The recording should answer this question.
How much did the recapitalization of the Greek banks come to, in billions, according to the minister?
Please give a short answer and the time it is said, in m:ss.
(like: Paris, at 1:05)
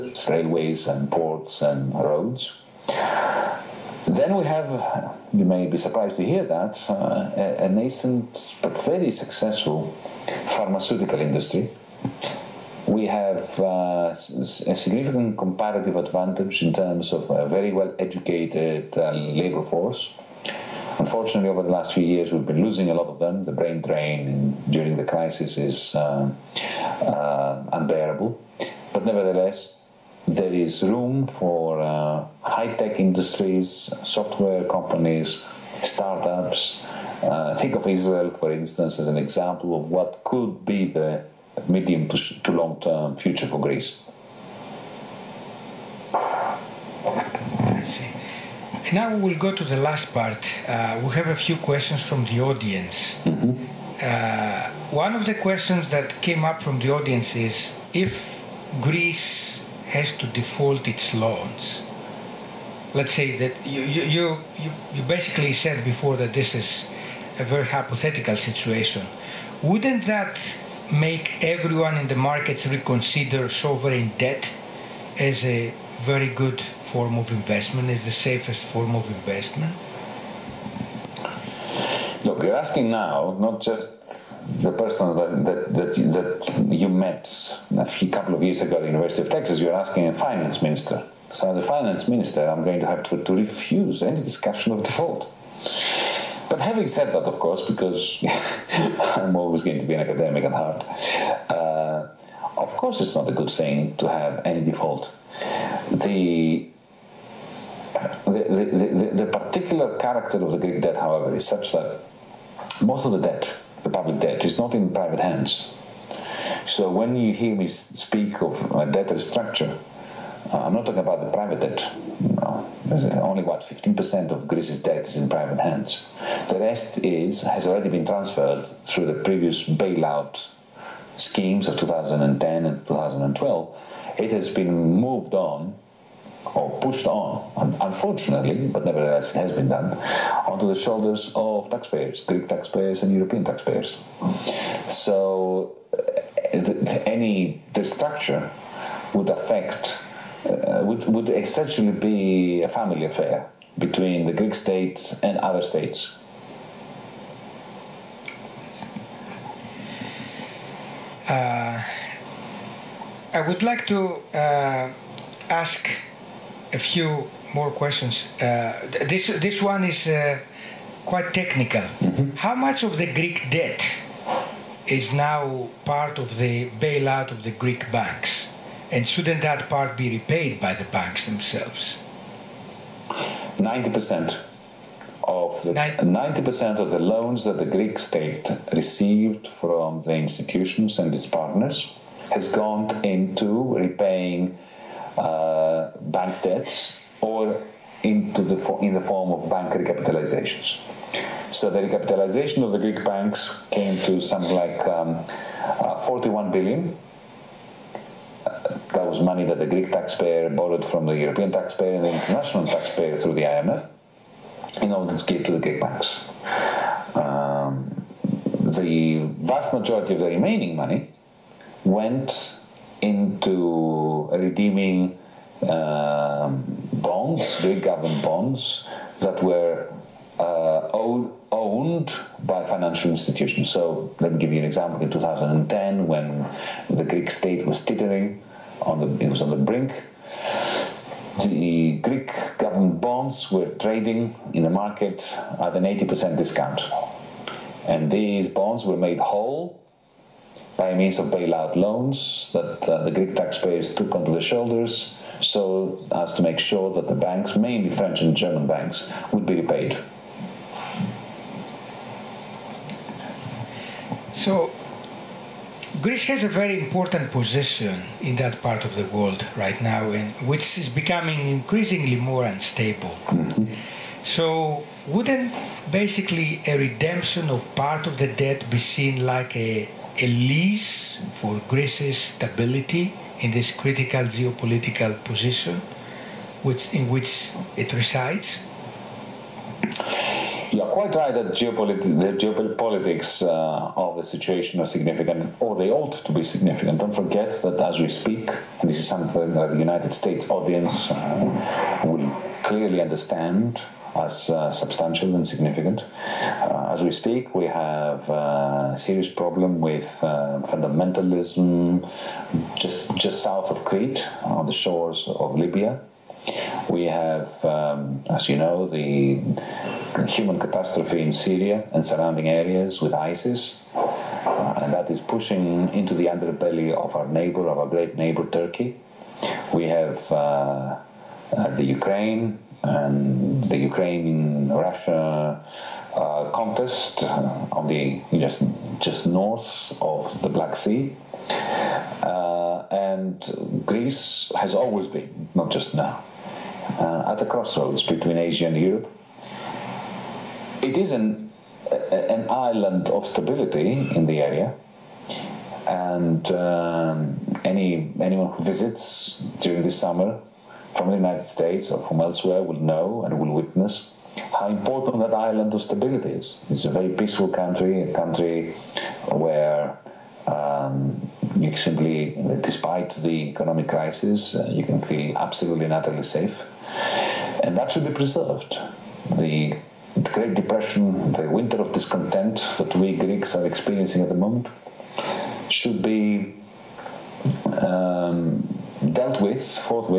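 41 billion, at 3:25.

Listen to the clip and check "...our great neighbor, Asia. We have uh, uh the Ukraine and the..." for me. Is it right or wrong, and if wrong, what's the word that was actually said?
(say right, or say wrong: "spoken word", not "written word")
wrong: "Turkey", not "Asia".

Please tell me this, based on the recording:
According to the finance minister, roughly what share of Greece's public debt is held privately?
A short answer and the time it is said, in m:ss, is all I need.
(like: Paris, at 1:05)
15%, at 2:03.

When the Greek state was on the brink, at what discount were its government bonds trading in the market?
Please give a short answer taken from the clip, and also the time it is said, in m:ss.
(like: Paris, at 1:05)
80%, at 4:05.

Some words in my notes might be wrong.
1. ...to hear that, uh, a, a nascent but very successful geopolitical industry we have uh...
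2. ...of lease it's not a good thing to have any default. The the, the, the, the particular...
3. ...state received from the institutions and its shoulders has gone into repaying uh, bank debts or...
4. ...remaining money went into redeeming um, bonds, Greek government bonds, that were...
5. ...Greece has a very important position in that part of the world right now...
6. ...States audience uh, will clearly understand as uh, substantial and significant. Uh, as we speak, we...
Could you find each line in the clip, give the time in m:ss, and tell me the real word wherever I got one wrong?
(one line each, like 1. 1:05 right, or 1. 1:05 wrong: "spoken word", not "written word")
1. 0:06 wrong: "pharmaceutical", not "geopolitical"
2. 1:42 wrong: "course", not "lease"
3. 3:07 wrong: "partners", not "shoulders"
4. 3:40 right
5. 4:26 right
6. 5:00 right.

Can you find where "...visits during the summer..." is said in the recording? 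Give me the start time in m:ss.
5:58.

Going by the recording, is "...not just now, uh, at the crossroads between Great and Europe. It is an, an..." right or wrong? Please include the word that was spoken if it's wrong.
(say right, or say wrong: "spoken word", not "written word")
wrong: "Asia", not "Great".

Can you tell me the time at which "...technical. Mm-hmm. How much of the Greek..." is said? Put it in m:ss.
2:51.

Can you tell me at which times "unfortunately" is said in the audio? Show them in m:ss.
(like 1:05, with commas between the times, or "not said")
0:20, 2:17.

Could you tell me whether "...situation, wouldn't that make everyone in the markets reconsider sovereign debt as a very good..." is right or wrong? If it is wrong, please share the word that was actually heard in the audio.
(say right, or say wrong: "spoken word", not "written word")
right.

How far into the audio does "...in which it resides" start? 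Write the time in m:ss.
4:46.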